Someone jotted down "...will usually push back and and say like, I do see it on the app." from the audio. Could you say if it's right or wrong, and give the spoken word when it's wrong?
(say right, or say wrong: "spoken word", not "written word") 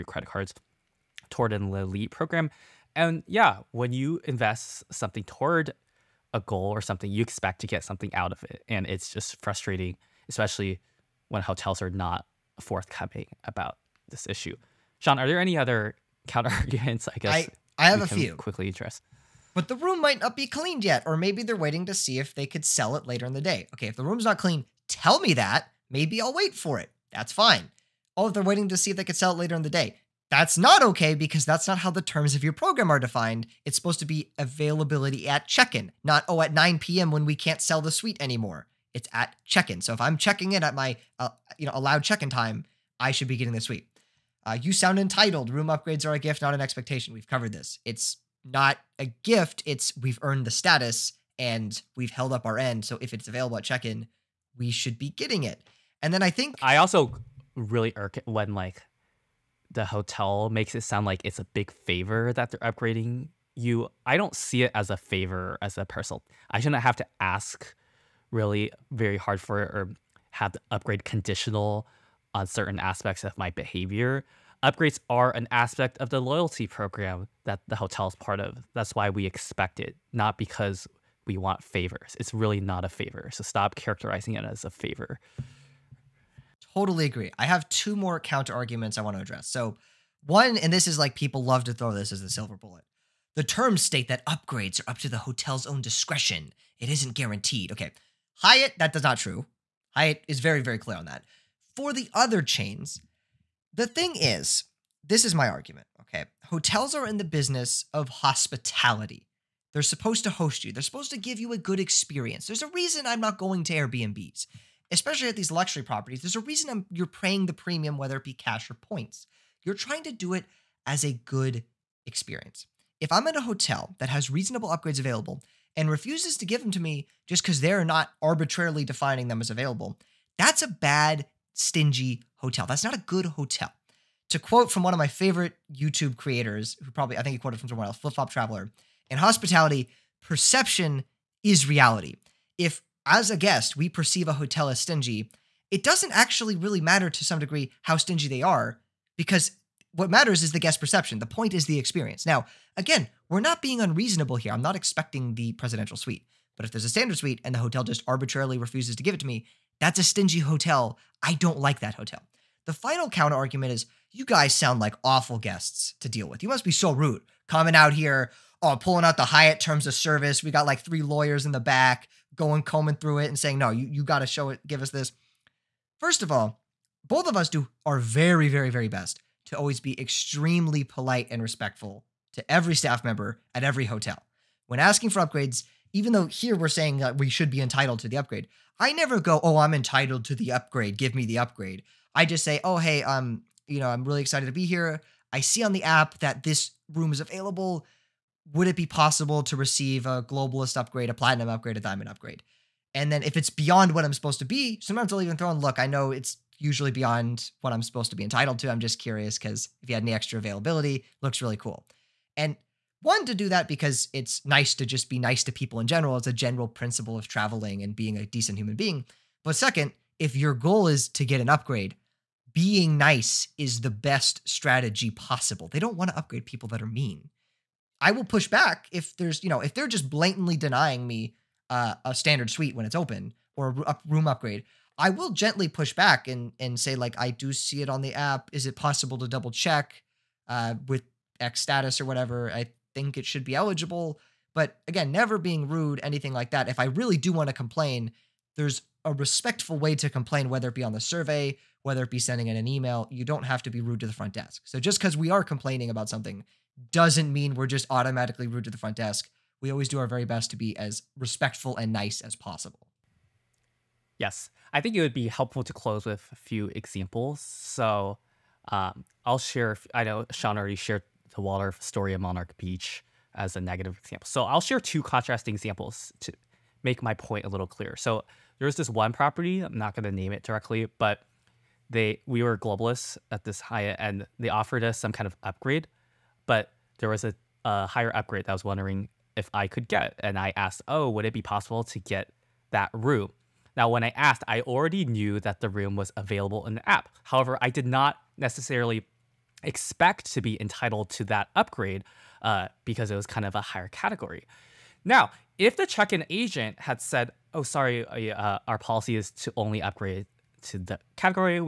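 wrong: "gently", not "usually".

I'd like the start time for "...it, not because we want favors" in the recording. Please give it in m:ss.
1:19.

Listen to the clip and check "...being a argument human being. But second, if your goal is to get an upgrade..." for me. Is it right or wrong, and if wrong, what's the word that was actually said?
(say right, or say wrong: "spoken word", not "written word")
wrong: "decent", not "argument".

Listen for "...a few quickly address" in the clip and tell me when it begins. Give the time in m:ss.
0:18.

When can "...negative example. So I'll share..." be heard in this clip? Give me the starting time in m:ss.
4:33.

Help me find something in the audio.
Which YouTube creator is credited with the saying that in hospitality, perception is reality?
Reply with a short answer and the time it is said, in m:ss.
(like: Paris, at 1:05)
Flip Flop Traveler, at 2:17.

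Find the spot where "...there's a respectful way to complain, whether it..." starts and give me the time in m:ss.
4:08.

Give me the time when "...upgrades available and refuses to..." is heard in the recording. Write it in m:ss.
2:04.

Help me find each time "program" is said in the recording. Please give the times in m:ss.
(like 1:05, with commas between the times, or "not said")
0:02, 0:32, 1:16.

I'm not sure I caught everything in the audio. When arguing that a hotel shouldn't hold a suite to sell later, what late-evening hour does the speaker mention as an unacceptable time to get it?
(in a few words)
9 p.m.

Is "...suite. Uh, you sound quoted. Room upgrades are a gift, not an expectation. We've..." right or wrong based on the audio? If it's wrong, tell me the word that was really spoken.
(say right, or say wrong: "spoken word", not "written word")
wrong: "entitled", not "quoted".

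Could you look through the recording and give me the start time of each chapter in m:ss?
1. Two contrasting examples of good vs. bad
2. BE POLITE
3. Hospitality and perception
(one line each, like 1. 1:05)
1. 4:23
2. 2:42
3. 1:27.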